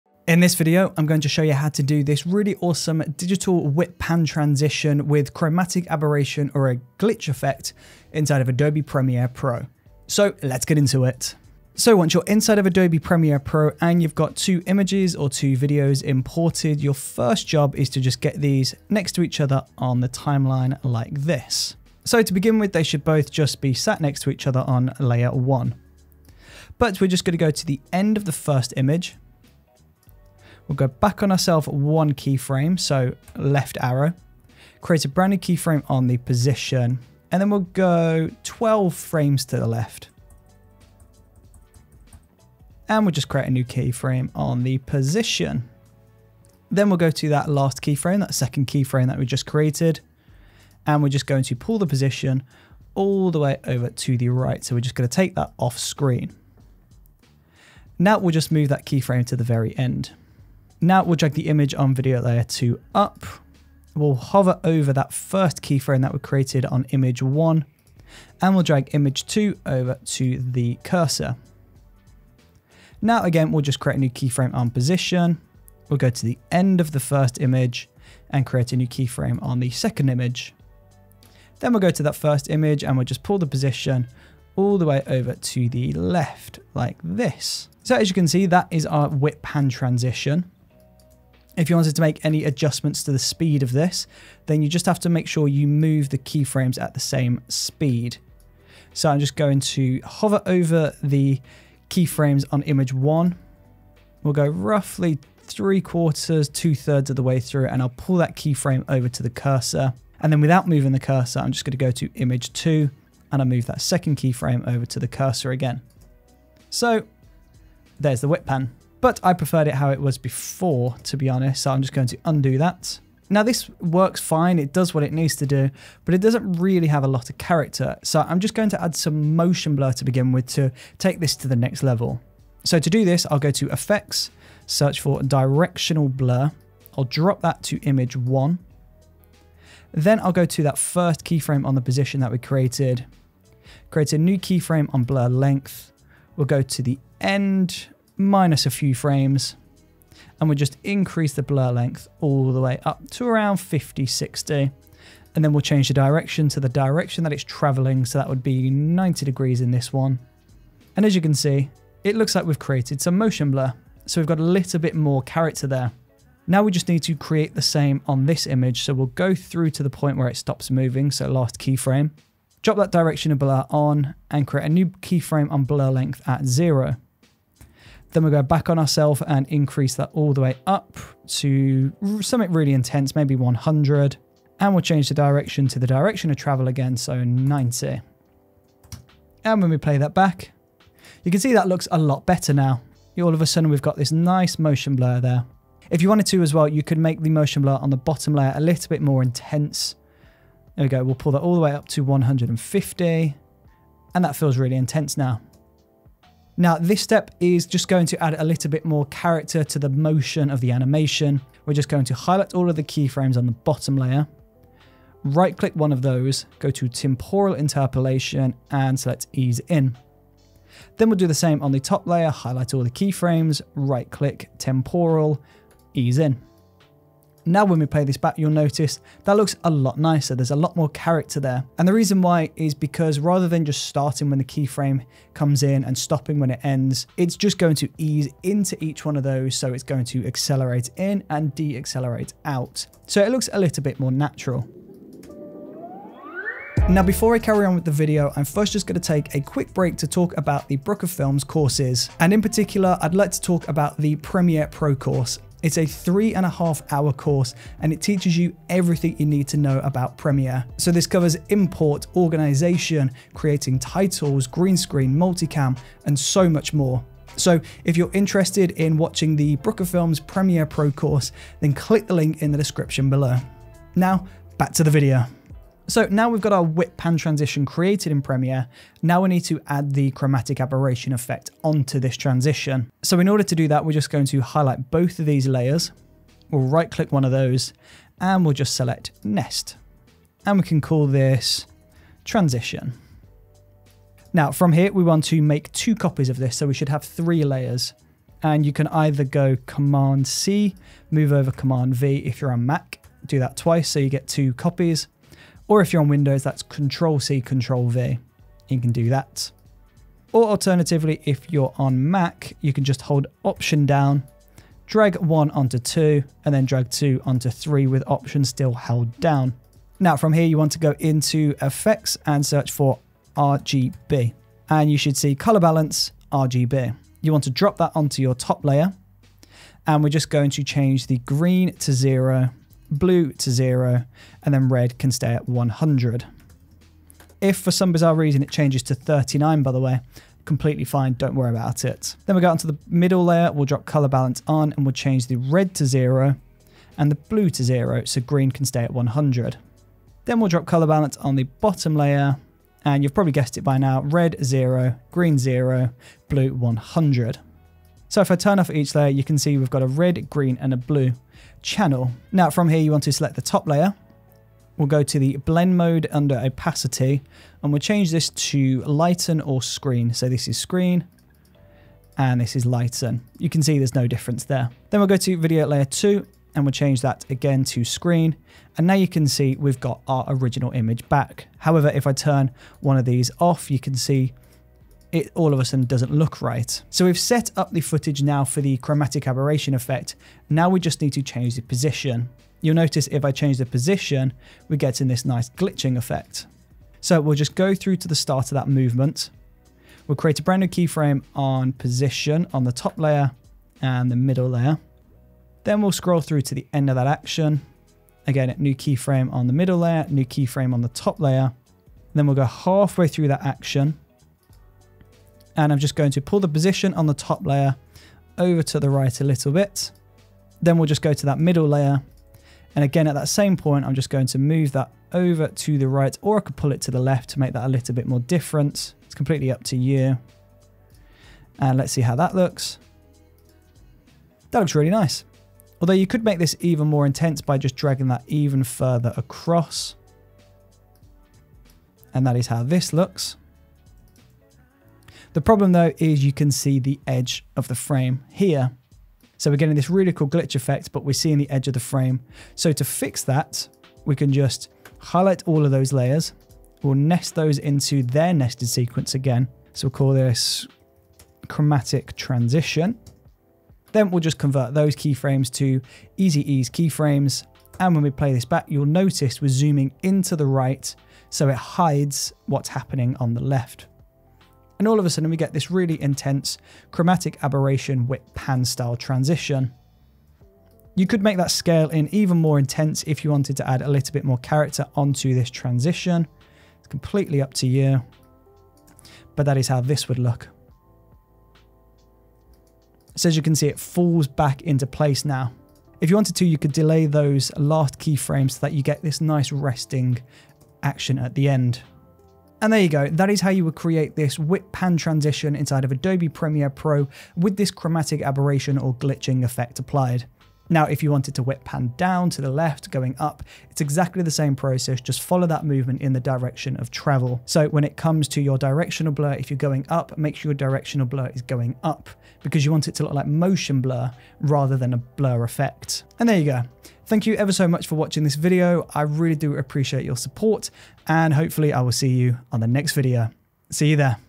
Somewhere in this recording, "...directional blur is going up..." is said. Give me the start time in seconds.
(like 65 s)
520 s.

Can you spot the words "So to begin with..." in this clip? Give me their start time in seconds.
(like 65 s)
22 s.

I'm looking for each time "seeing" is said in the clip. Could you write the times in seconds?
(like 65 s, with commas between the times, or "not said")
451 s.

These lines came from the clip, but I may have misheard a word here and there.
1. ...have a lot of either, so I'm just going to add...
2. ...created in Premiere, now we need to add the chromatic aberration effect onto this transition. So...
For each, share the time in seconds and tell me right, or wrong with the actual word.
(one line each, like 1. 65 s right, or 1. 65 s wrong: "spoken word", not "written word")
1. 126 s wrong: "character", not "either"
2. 277 s right.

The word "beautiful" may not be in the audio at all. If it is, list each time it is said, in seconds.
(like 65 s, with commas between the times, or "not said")
not said.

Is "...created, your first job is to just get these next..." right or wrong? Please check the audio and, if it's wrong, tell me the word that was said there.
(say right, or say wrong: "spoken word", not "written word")
wrong: "imported", not "created".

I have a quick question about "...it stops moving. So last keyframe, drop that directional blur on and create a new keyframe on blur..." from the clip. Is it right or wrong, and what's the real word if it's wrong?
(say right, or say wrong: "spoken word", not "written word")
right.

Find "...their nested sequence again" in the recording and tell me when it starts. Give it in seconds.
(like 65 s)
458 s.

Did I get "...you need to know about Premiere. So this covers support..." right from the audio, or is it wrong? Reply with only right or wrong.
wrong.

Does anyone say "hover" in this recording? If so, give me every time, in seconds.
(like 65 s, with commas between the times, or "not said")
64 s, 100 s.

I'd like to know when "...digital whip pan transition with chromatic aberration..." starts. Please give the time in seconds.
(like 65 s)
3 s.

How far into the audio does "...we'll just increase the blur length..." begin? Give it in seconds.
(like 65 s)
150 s.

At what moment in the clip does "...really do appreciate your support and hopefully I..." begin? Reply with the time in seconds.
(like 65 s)
529 s.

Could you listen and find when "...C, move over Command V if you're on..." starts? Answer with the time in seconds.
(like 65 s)
300 s.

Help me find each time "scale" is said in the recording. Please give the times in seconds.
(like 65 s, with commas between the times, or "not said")
481 s.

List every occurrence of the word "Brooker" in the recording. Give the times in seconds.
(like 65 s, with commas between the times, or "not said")
250 s, 269 s.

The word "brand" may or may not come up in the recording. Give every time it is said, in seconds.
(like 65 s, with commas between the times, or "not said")
35 s, 400 s.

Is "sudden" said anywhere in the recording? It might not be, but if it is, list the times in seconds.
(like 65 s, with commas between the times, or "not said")
193 s, 385 s, 475 s.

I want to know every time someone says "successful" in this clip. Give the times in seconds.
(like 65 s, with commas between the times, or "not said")
not said.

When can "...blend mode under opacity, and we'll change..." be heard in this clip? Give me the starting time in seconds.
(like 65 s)
365 s.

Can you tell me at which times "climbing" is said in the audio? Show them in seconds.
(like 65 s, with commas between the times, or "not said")
not said.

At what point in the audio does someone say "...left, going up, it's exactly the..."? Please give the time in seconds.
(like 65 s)
512 s.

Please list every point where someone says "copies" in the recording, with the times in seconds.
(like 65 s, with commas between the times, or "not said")
295 s, 304 s.